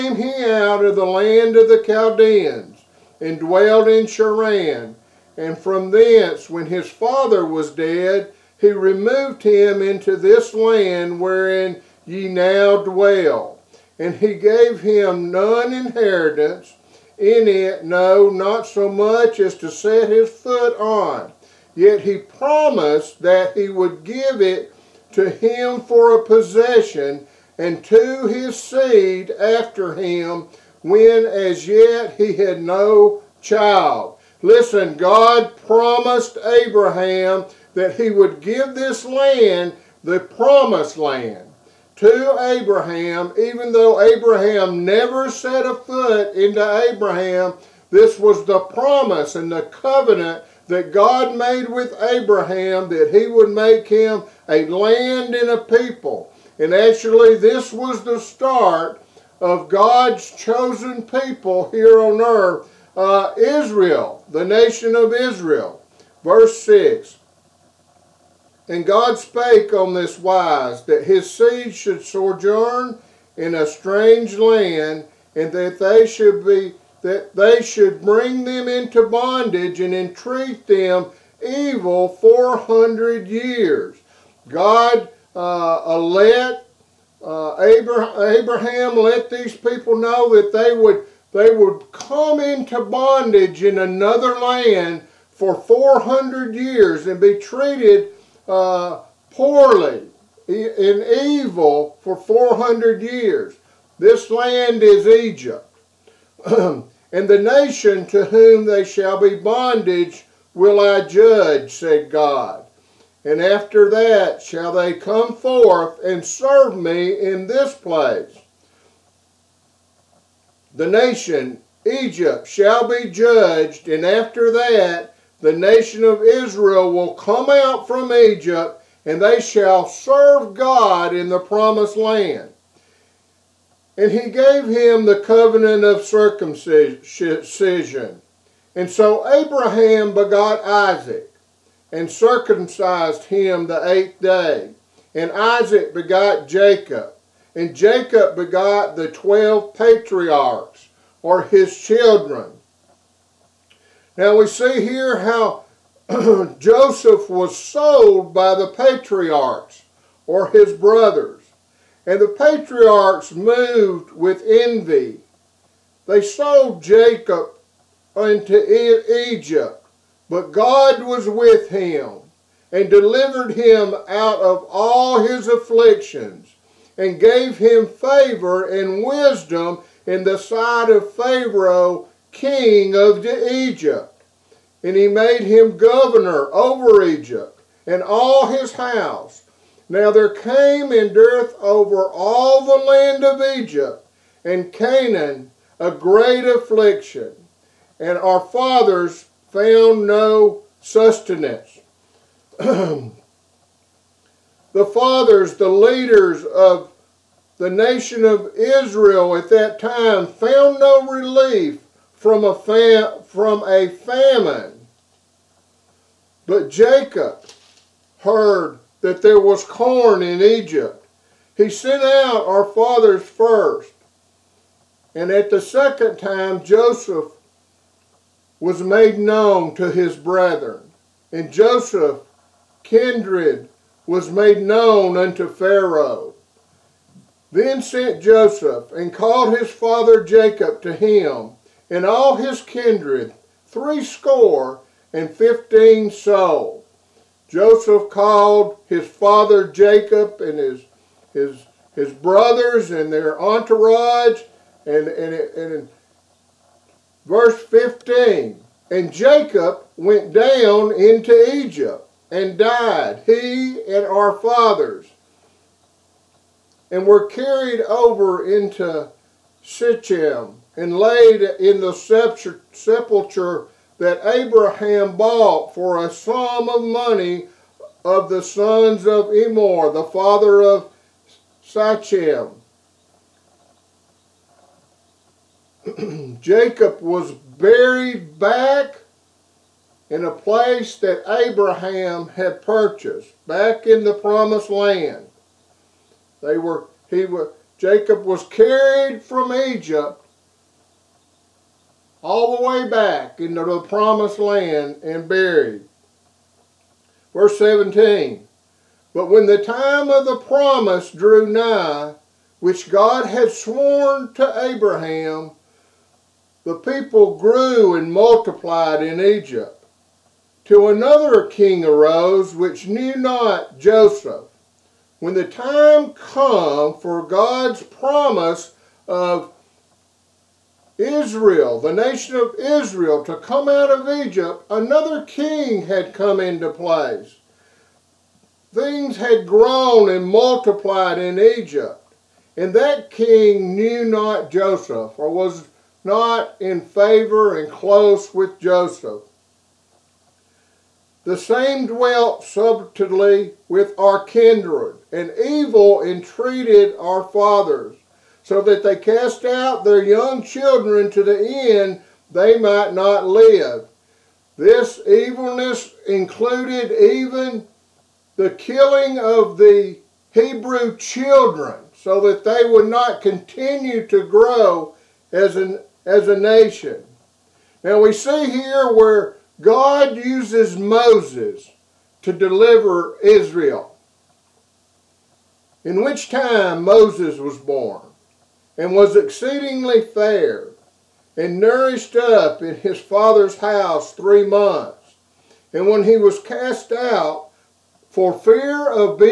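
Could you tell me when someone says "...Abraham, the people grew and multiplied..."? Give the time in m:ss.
5:14.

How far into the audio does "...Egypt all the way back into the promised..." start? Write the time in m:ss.
4:59.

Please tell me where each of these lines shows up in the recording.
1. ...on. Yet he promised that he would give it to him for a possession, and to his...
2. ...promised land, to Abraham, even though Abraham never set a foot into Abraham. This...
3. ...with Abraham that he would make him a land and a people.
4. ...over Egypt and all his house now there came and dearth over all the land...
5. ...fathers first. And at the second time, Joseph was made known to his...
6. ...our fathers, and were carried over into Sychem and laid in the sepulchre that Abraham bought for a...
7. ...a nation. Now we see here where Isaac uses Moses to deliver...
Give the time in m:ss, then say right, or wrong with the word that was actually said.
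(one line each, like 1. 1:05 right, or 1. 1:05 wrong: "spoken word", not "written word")
1. 0:20 right
2. 0:40 right
3. 0:51 right
4. 3:06 right
5. 3:42 right
6. 4:24 right
7. 6:16 wrong: "God", not "Isaac".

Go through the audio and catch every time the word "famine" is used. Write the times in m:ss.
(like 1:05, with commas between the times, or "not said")
3:33.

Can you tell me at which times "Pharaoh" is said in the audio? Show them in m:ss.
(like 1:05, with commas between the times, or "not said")
3:01, 3:55.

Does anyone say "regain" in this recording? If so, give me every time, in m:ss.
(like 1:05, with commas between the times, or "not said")
not said.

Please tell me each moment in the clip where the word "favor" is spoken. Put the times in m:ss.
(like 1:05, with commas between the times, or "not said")
2:57, 5:46.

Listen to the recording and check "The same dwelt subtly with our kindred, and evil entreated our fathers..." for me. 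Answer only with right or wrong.
right.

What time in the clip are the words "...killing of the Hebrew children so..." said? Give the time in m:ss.
6:08.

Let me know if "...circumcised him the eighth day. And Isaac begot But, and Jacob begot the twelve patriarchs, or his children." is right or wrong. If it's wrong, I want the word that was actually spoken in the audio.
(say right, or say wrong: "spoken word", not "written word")
wrong: "Jacob", not "But".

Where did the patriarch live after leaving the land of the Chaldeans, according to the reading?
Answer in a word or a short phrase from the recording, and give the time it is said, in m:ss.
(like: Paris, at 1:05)
Sharan, at 0:04.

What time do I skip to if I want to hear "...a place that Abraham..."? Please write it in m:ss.
4:50.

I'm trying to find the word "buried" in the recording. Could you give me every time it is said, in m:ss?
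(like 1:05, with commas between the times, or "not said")
4:47, 5:05.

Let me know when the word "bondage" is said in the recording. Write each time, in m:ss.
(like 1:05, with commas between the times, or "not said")
1:19, 1:32, 1:49.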